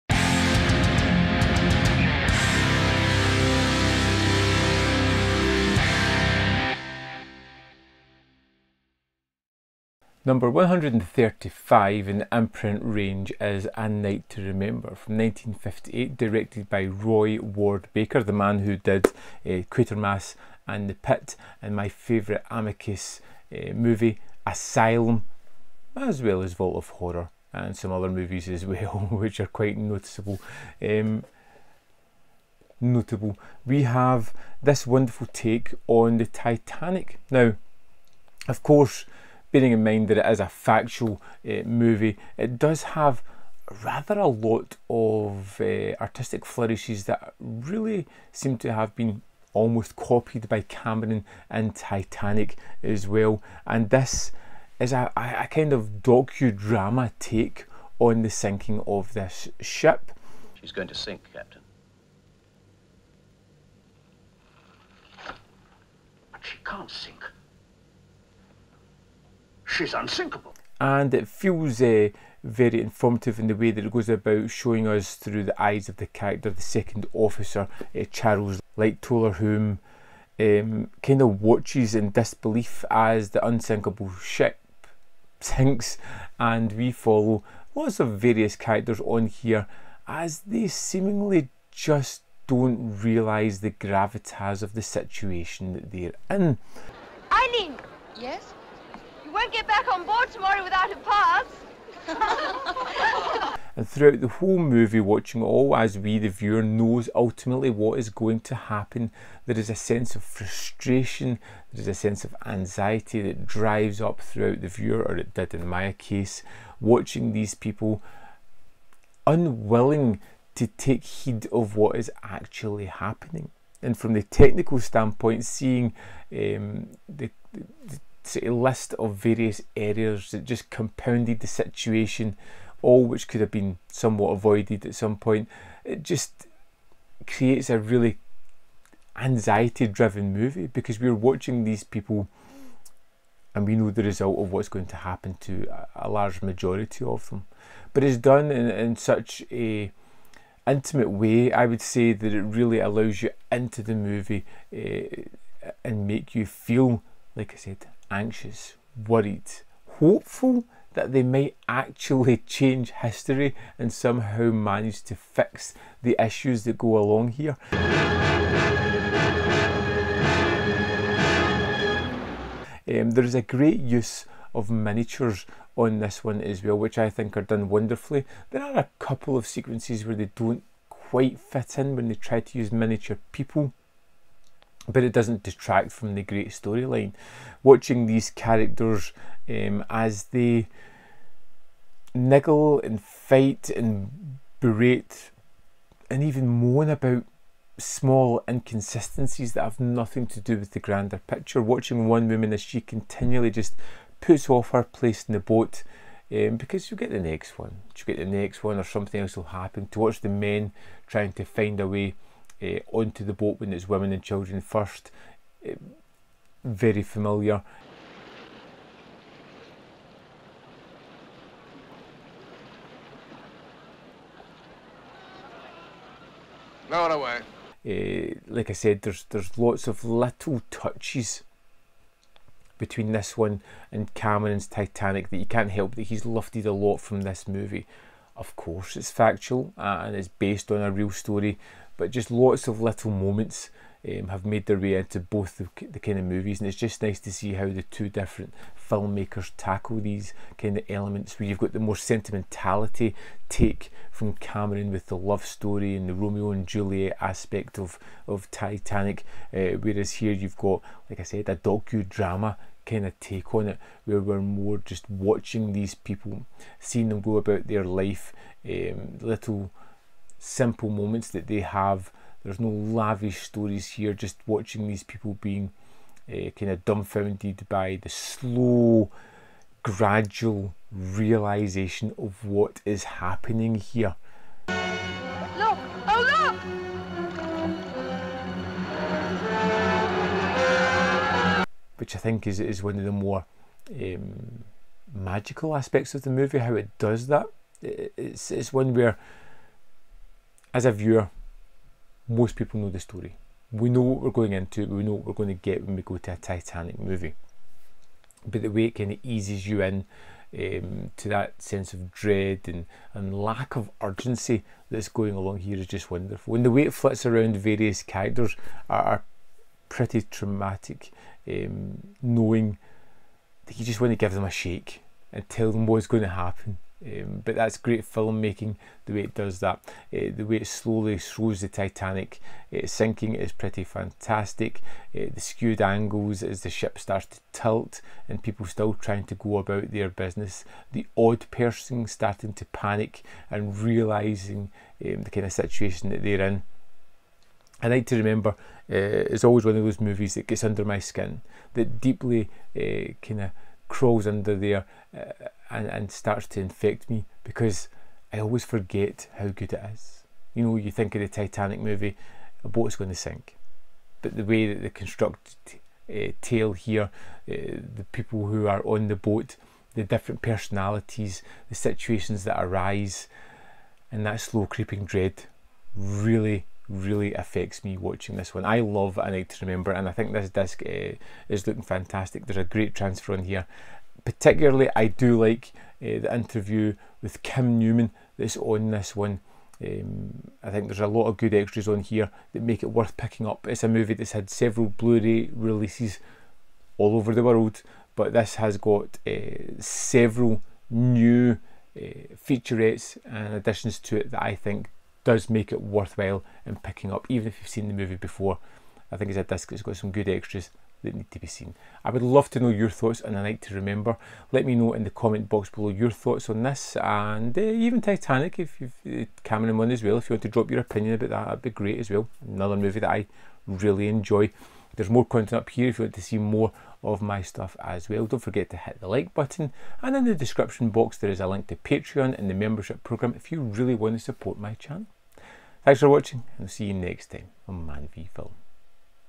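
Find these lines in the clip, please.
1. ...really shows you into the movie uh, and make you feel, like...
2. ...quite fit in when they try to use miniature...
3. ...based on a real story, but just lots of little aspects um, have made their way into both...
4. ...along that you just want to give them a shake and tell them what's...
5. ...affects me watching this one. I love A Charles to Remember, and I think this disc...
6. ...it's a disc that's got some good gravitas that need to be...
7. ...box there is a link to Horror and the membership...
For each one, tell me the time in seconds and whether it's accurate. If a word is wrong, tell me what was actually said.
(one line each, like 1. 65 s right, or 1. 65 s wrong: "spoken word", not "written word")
1. 152 s wrong: "allows", not "shows"
2. 180 s right
3. 240 s wrong: "moments", not "aspects"
4. 322 s wrong: "knowing", not "along"
5. 377 s wrong: "Night", not "Charles"
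6. 409 s wrong: "extras", not "gravitas"
7. 430 s wrong: "Patreon", not "Horror".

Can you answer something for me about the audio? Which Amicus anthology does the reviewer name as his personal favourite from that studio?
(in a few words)
Asylum.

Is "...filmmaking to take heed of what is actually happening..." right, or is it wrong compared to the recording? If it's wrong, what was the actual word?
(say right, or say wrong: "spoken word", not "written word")
wrong: "unwilling", not "filmmaking".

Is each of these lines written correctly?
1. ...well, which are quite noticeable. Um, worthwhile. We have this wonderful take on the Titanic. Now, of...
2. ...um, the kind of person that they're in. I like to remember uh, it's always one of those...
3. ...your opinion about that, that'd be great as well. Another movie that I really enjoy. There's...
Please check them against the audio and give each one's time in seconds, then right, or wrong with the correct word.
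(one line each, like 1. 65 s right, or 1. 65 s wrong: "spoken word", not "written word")
1. 28 s wrong: "notable", not "worthwhile"
2. 345 s wrong: "situation", not "person"
3. 420 s right.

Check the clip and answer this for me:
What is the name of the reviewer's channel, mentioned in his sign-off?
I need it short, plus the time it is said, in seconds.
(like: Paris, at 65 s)
Man v Film, at 437 s.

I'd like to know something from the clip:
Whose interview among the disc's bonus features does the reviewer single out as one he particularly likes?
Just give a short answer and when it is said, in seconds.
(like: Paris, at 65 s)
Kim Newman, at 387 s.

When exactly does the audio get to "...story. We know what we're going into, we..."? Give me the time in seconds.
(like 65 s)
302 s.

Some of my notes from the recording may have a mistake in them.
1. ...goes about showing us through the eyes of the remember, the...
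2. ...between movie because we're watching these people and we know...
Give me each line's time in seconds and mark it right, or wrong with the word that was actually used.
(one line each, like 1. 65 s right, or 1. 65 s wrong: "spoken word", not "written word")
1. 73 s wrong: "character", not "remember"
2. 139 s wrong: "driven", not "between".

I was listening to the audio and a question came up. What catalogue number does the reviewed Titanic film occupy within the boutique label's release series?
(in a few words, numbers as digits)
135.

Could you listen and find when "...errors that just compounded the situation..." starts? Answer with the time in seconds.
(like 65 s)
129 s.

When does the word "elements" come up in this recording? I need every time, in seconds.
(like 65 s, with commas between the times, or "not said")
250 s.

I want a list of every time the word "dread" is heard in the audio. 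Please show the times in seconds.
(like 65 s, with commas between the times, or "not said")
312 s, 375 s.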